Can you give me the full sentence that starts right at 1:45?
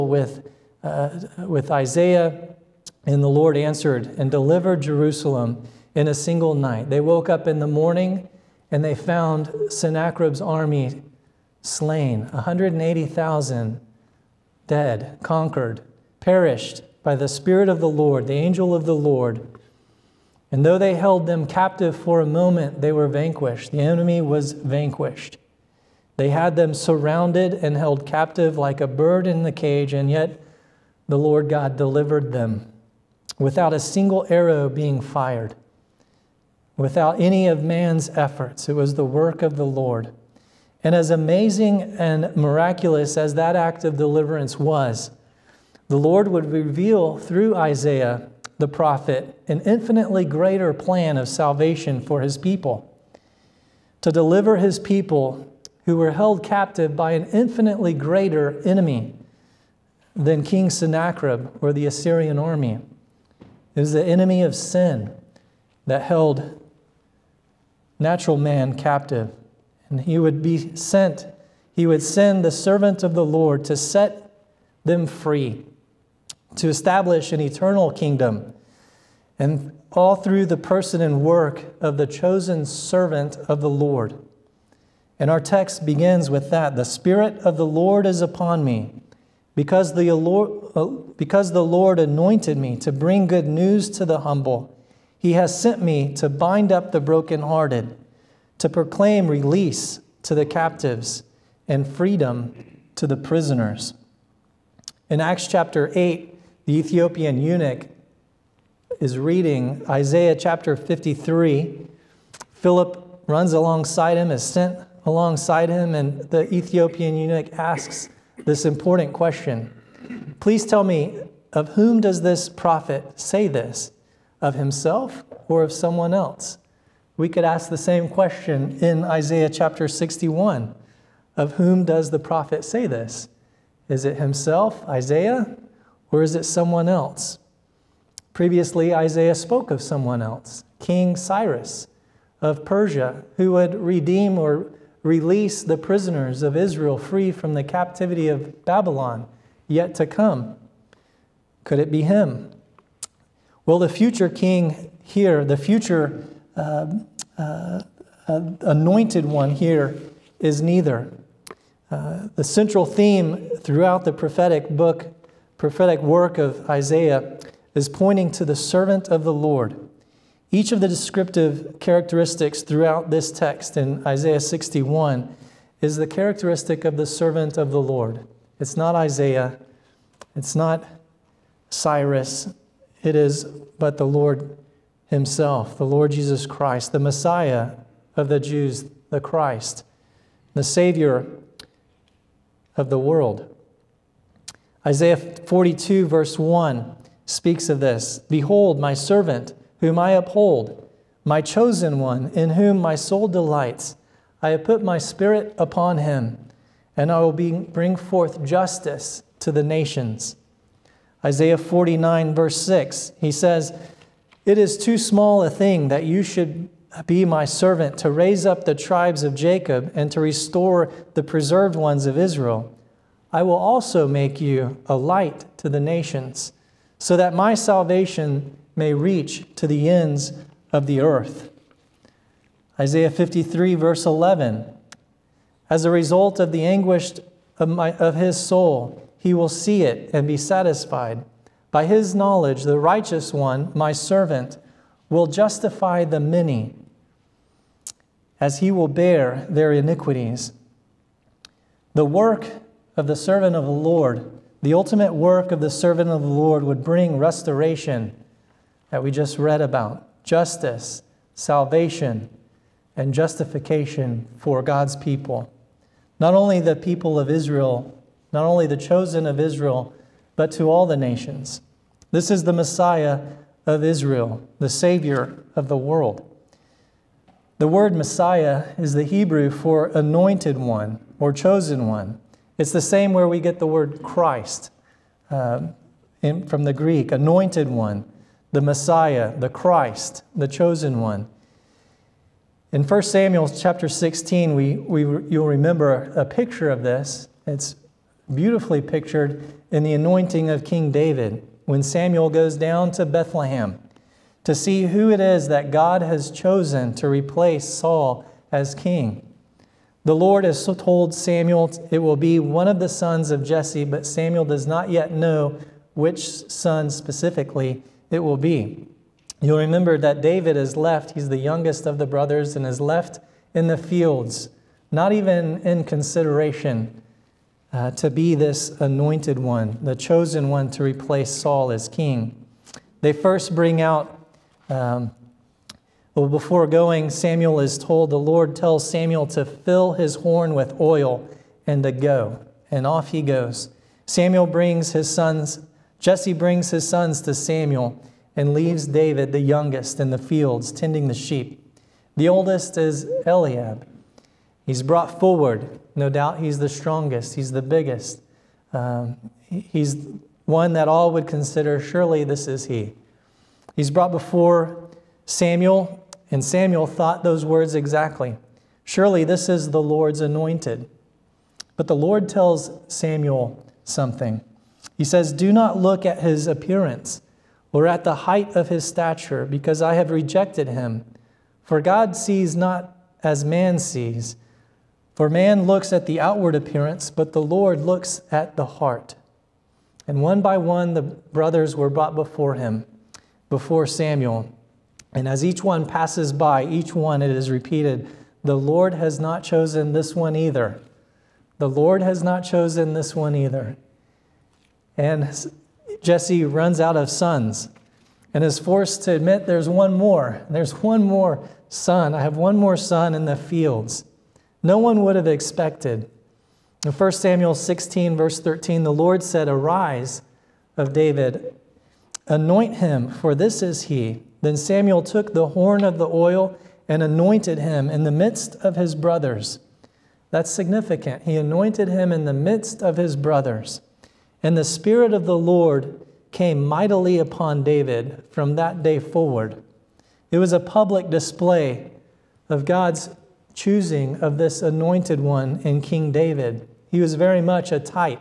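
In Acts chapter 8, the Ethiopian eunuch is reading Isaiah chapter 53.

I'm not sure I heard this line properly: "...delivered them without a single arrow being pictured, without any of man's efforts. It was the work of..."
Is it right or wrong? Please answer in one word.
wrong.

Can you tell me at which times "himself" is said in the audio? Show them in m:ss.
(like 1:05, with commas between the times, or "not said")
2:04, 2:14, 3:05.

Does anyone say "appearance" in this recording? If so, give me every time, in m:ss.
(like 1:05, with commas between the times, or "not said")
6:16, 6:26.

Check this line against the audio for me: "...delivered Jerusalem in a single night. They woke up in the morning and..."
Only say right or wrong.
right.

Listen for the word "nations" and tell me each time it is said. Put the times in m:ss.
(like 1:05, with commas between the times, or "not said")
3:29, 3:45, 4:30.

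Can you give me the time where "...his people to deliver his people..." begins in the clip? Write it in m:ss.
0:52.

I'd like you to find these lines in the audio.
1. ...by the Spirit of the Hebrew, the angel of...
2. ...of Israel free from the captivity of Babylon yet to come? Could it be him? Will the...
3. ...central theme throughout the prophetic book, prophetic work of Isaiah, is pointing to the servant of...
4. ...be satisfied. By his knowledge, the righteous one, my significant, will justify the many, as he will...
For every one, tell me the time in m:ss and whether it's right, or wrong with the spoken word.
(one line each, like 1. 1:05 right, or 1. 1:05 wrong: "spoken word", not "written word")
1. 0:17 wrong: "Lord", not "Hebrew"
2. 2:26 right
3. 2:42 right
4. 4:00 wrong: "servant", not "significant".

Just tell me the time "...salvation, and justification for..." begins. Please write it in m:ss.
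4:21.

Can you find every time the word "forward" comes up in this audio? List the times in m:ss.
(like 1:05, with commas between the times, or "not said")
5:55, 7:18.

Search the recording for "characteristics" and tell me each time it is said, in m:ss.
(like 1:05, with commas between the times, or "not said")
2:51, 2:56.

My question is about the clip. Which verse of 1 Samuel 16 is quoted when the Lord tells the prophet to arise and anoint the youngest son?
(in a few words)
13.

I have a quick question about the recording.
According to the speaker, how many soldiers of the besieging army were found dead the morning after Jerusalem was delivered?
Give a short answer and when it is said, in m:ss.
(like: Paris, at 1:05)
180,000, at 0:12.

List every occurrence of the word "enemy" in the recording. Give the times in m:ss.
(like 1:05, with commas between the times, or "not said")
0:23, 0:58, 1:04.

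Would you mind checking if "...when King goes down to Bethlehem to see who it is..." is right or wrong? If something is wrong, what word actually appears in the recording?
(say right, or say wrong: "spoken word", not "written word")
wrong: "Samuel", not "King".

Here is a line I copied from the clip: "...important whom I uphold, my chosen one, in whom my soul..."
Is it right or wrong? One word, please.
wrong.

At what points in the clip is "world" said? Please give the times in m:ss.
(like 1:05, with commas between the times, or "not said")
3:12, 4:35.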